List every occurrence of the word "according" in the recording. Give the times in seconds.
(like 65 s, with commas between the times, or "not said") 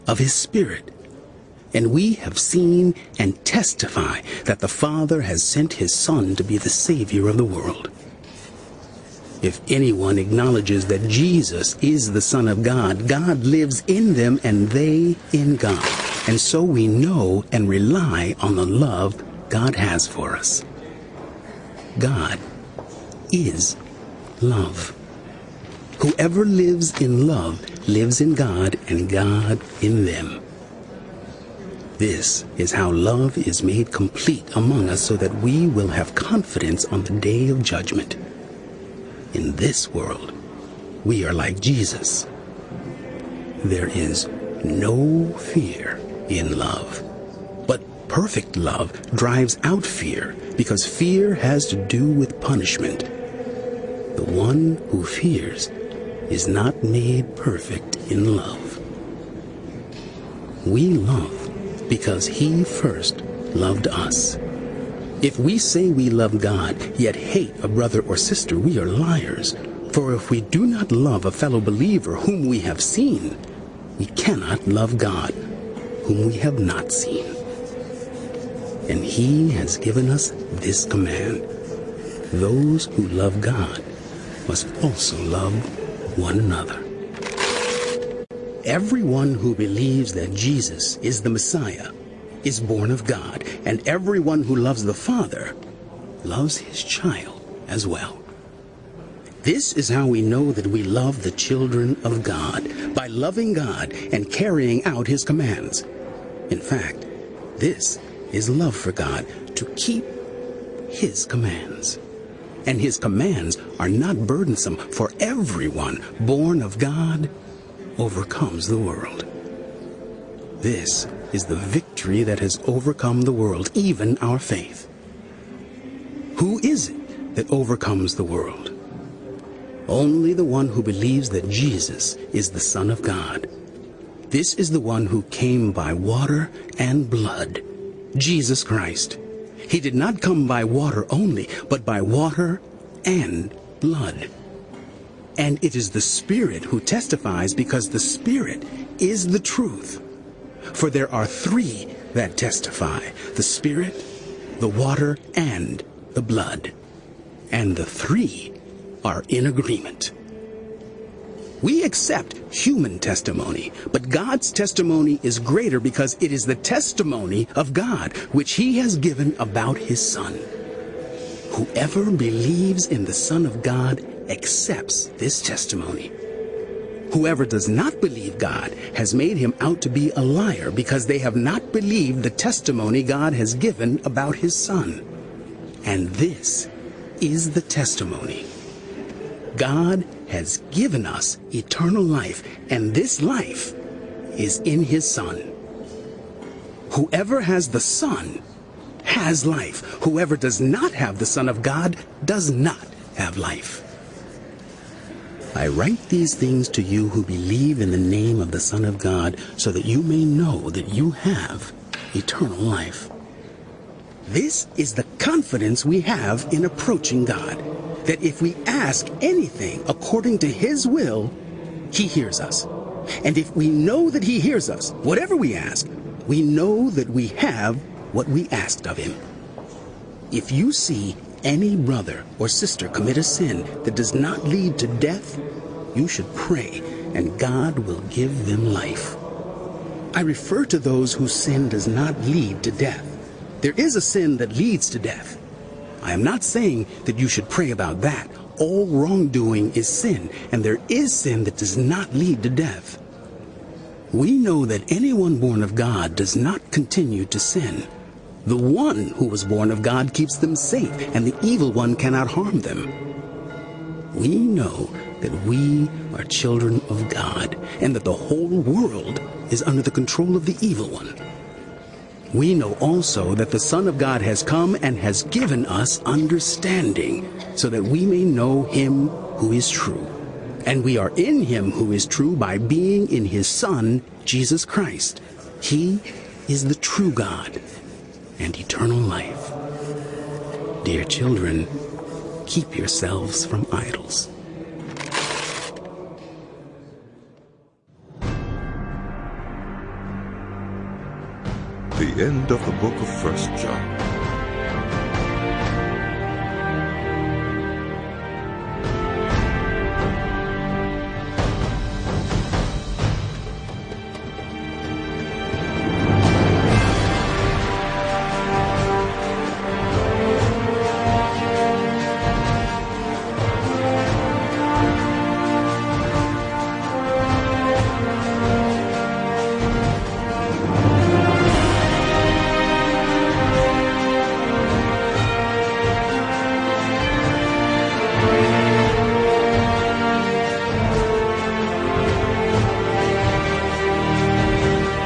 219 s.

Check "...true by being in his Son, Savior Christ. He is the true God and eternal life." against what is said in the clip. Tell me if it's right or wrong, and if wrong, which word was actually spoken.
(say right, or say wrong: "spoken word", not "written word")
wrong: "Jesus", not "Savior".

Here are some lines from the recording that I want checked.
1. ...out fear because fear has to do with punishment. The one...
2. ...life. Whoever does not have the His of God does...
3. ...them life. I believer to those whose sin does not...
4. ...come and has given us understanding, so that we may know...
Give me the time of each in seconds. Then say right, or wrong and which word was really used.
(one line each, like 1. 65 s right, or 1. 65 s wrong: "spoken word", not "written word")
1. 49 s right
2. 199 s wrong: "Son", not "His"
3. 238 s wrong: "refer", not "believer"
4. 274 s right.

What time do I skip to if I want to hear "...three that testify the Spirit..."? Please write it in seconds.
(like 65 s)
151 s.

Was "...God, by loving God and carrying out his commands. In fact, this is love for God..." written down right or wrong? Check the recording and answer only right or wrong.
right.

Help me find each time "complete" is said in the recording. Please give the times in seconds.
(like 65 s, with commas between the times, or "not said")
33 s.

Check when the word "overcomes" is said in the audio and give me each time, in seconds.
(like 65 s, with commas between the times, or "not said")
117 s, 122 s, 127 s.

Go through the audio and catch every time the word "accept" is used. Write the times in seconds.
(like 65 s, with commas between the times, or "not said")
161 s, 174 s.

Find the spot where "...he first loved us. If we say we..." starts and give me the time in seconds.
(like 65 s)
62 s.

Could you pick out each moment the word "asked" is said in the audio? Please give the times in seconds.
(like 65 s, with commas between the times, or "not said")
228 s.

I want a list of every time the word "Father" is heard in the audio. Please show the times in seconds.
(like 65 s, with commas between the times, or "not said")
4 s, 94 s.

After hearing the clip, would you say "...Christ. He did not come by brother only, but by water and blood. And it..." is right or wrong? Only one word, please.
wrong.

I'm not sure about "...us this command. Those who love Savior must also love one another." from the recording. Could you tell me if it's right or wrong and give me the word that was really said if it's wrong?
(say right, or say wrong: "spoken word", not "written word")
wrong: "God", not "Savior".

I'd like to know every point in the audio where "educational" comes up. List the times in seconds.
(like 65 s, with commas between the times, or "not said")
not said.